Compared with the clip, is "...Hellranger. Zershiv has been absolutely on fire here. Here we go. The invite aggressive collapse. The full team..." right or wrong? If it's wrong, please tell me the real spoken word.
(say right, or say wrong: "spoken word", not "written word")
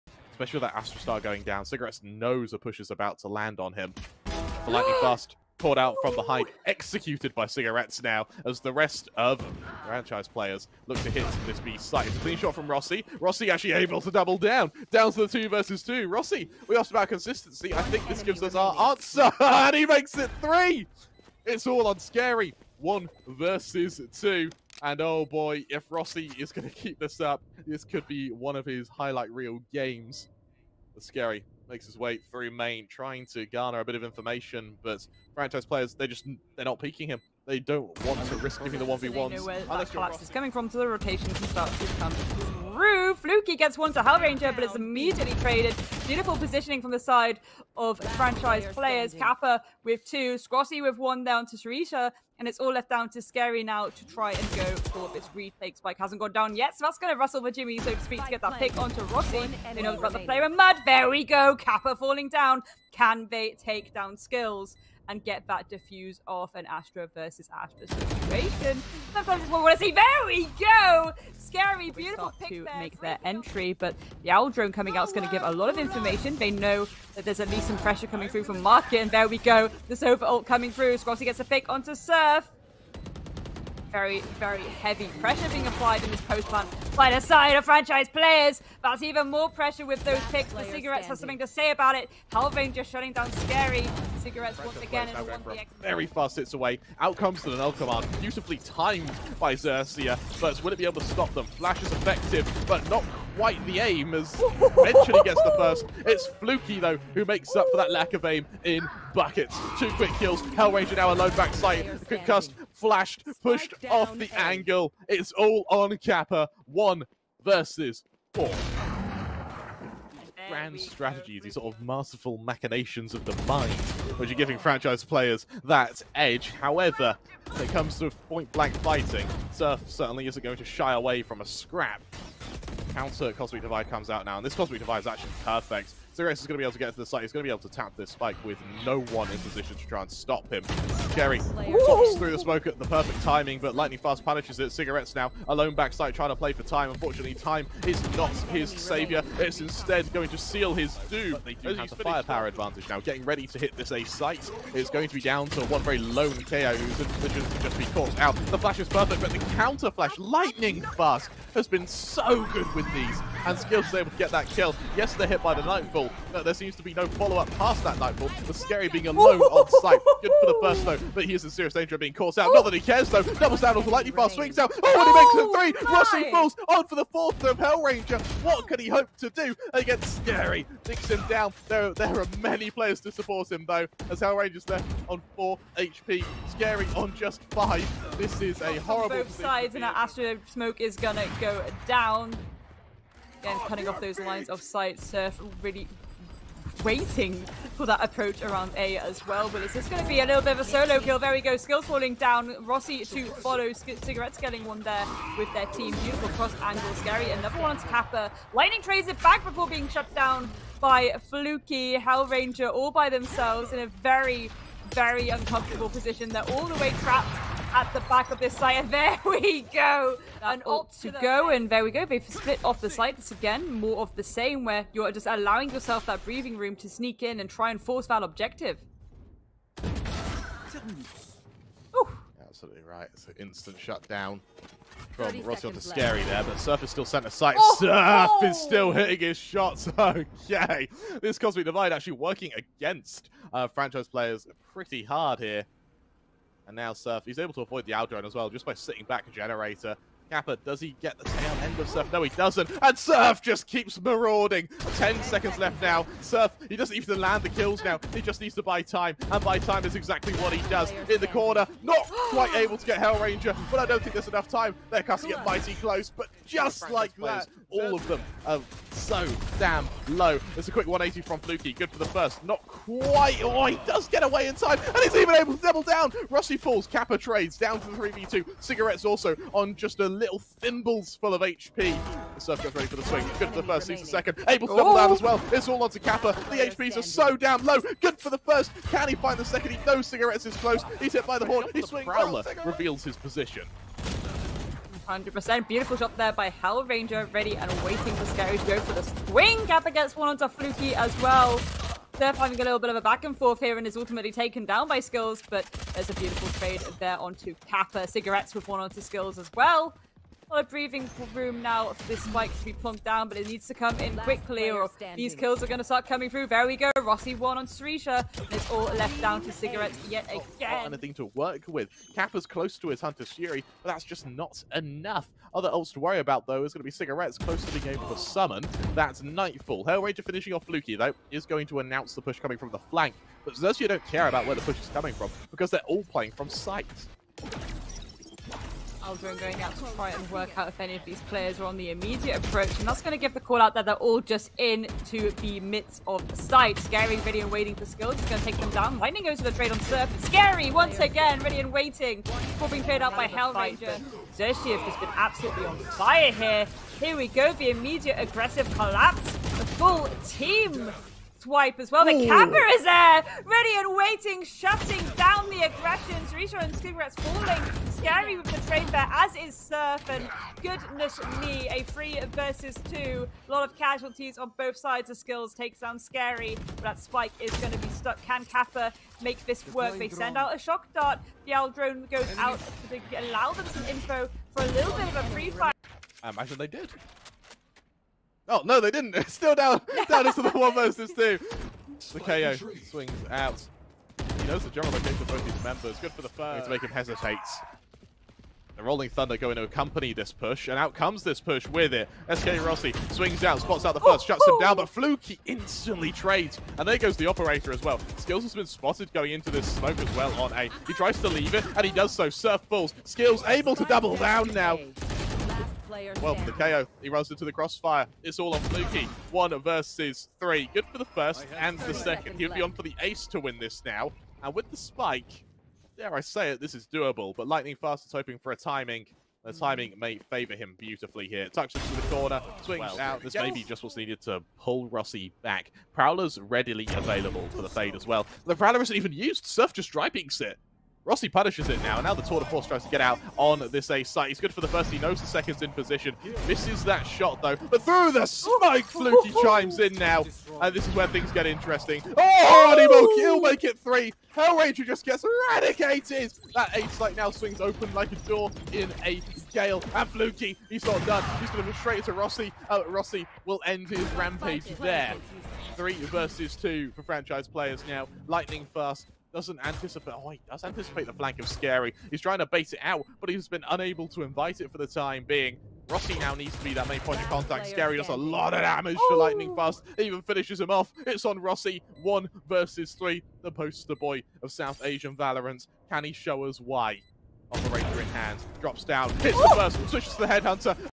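wrong: "immediate", not "invite".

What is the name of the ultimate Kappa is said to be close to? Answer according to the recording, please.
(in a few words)
Hunter's Fury.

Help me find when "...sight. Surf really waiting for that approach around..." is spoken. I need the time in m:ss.
3:14.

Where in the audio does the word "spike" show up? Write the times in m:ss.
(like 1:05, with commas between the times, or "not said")
0:55, 2:18, 5:12, 6:16, 7:04, 7:28.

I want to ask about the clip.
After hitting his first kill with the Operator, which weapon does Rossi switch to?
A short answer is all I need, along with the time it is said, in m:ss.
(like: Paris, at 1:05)
Headhunter, at 8:10.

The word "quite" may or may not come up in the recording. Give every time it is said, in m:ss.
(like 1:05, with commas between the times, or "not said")
1:43, 4:22, 4:32.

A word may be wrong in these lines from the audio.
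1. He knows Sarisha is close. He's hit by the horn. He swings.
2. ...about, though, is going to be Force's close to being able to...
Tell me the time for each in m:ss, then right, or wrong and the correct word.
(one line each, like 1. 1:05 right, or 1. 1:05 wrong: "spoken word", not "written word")
1. 4:49 wrong: "Cigarettes", not "Sarisha"
2. 5:26 wrong: "Cigarette", not "Force".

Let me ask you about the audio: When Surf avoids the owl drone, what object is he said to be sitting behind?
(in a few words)
a generator.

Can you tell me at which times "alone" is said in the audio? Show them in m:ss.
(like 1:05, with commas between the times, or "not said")
1:51, 2:25, 2:49.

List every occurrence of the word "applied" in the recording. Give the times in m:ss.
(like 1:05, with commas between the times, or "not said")
1:25.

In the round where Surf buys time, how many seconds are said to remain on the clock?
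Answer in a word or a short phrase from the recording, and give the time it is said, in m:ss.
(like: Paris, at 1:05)
10, at 4:14.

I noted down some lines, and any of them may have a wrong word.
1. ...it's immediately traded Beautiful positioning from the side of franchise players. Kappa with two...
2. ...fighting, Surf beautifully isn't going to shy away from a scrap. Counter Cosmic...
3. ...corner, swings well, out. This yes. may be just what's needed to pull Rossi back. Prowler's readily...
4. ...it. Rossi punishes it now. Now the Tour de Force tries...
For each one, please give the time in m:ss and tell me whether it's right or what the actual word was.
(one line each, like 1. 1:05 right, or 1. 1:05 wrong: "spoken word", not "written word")
1. 0:44 right
2. 2:08 wrong: "certainly", not "beautifully"
3. 7:12 right
4. 7:20 right.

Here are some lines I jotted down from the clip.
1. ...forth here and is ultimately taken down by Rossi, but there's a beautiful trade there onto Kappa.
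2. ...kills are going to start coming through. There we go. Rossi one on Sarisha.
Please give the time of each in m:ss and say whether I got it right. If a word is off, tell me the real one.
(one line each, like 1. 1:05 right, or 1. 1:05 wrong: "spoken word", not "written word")
1. 5:03 wrong: "Skills", not "Rossi"
2. 5:15 right.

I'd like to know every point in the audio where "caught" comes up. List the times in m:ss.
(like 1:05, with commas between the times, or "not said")
0:05, 2:37, 2:52.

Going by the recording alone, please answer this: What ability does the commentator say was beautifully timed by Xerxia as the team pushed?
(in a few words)
Nanel command.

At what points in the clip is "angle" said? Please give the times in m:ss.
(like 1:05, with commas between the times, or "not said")
1:54, 3:26.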